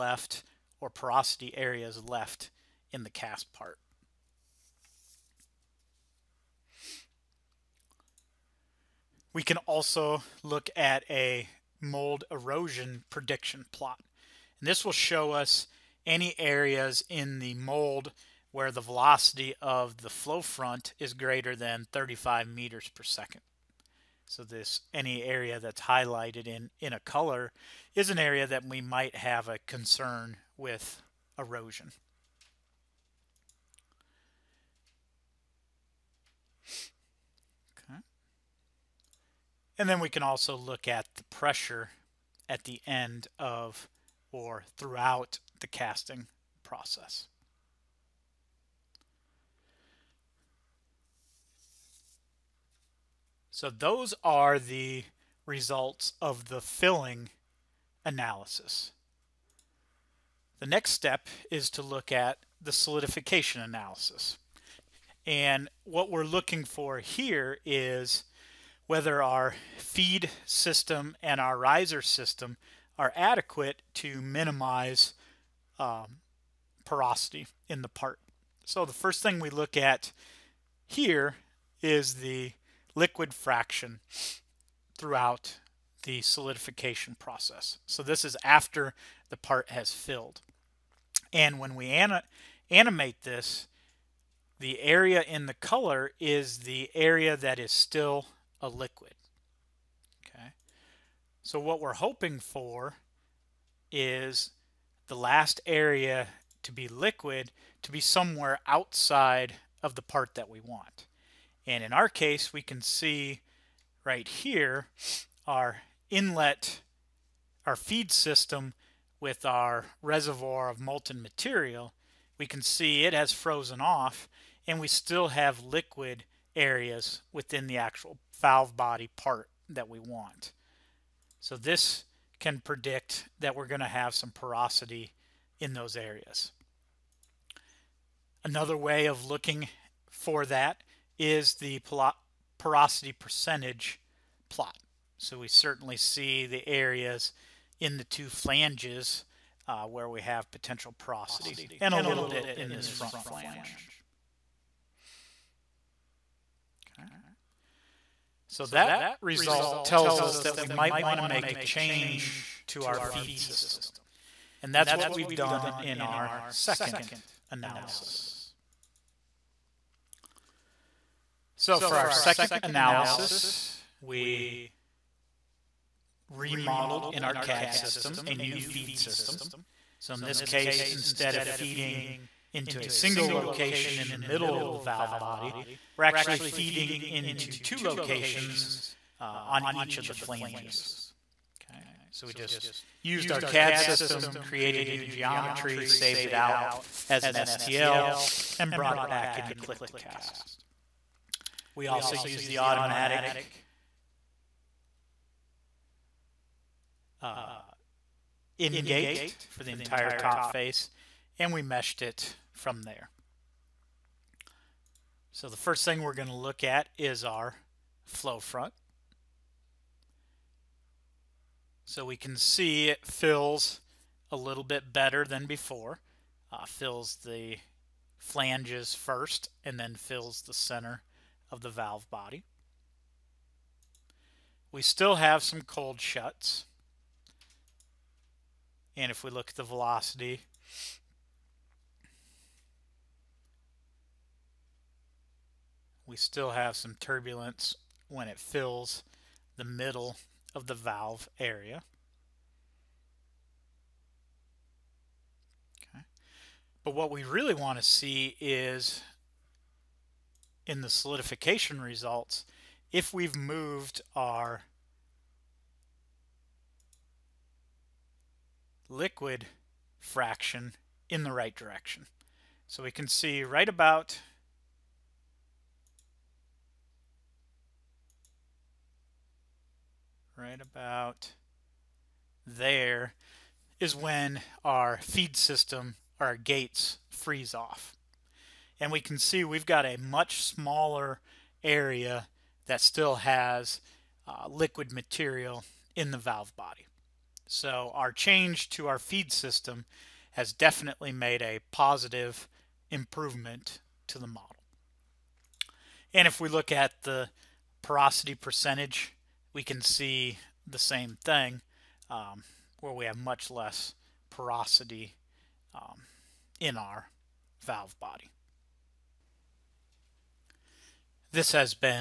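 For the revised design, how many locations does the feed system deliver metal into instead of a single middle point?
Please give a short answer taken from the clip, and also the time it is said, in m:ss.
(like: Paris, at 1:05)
2, at 3:07.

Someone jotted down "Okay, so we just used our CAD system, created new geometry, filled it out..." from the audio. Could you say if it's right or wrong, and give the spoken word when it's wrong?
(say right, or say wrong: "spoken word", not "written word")
wrong: "saved", not "filled".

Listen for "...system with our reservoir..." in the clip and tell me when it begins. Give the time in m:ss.
1:58.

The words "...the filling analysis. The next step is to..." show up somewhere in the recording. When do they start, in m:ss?
0:56.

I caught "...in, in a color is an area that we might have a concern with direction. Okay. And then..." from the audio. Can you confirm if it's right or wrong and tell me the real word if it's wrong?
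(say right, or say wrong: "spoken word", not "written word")
wrong: "erosion", not "direction".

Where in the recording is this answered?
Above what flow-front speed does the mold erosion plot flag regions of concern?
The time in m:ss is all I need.
0:21.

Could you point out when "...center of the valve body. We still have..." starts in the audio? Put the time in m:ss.
3:50.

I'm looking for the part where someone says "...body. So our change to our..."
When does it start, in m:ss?
4:56.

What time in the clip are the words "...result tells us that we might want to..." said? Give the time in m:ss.
2:39.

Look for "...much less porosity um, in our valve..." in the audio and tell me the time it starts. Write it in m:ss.
5:13.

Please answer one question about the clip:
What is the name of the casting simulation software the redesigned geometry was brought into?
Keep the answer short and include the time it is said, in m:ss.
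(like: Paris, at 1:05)
Click to Cast, at 3:19.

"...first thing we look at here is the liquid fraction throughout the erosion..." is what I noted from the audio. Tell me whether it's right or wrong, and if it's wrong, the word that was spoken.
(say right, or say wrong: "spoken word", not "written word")
wrong: "solidification", not "erosion".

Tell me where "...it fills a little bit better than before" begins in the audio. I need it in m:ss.
3:42.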